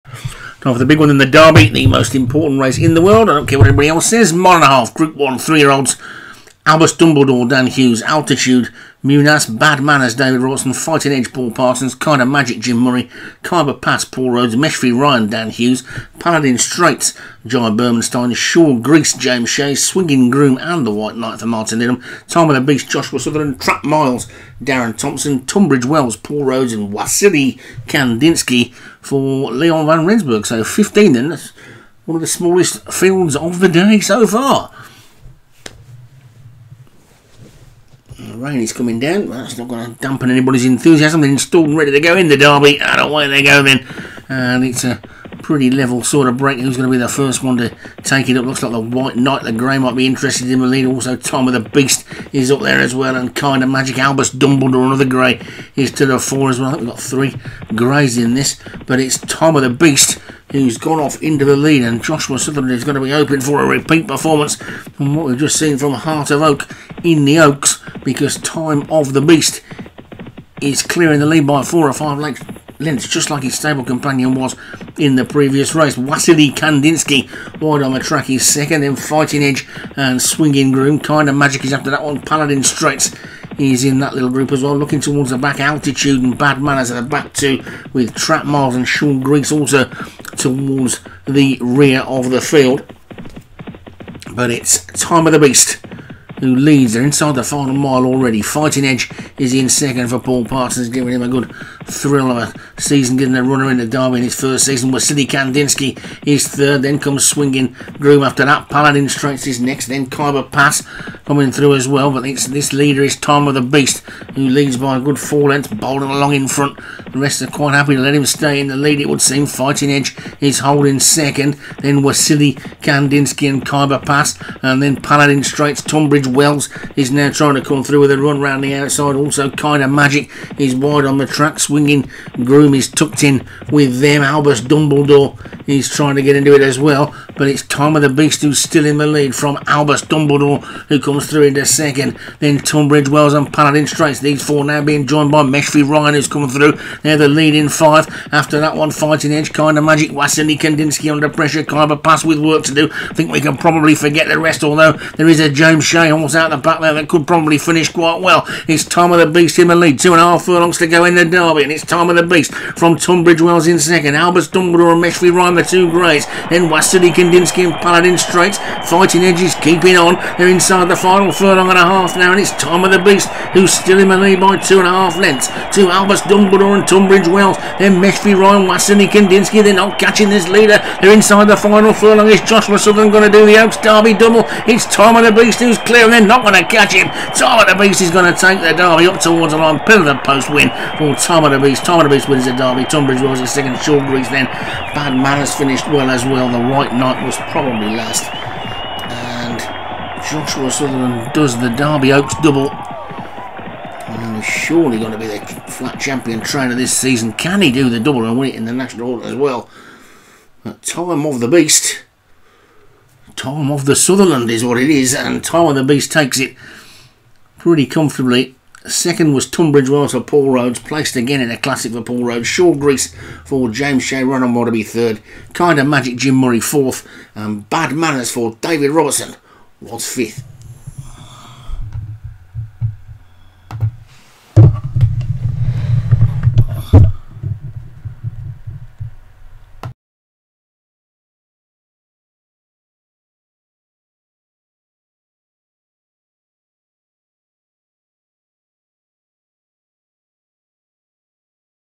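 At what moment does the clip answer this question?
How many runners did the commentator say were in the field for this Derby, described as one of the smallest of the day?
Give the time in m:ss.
0:30.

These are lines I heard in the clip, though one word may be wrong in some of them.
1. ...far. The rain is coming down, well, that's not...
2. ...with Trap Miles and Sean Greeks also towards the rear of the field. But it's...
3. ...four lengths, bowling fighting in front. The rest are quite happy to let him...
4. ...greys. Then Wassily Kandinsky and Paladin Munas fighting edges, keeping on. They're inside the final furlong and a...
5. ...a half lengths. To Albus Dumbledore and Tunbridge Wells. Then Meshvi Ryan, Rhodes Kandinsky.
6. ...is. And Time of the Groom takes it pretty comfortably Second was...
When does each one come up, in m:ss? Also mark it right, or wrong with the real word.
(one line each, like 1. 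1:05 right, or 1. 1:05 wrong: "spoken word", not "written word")
1. 0:34 right
2. 1:27 right
3. 1:55 wrong: "along", not "fighting"
4. 2:45 wrong: "Straits", not "Munas"
5. 2:54 wrong: "Wassily", not "Rhodes"
6. 3:34 wrong: "Beast", not "Groom".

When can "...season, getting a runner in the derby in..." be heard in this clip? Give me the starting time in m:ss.
1:42.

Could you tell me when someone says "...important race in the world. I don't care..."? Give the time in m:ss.
0:02.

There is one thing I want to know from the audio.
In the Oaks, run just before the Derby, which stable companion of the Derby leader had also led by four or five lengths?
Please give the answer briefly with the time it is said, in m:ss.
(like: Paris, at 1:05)
Heart of Oak, at 1:05.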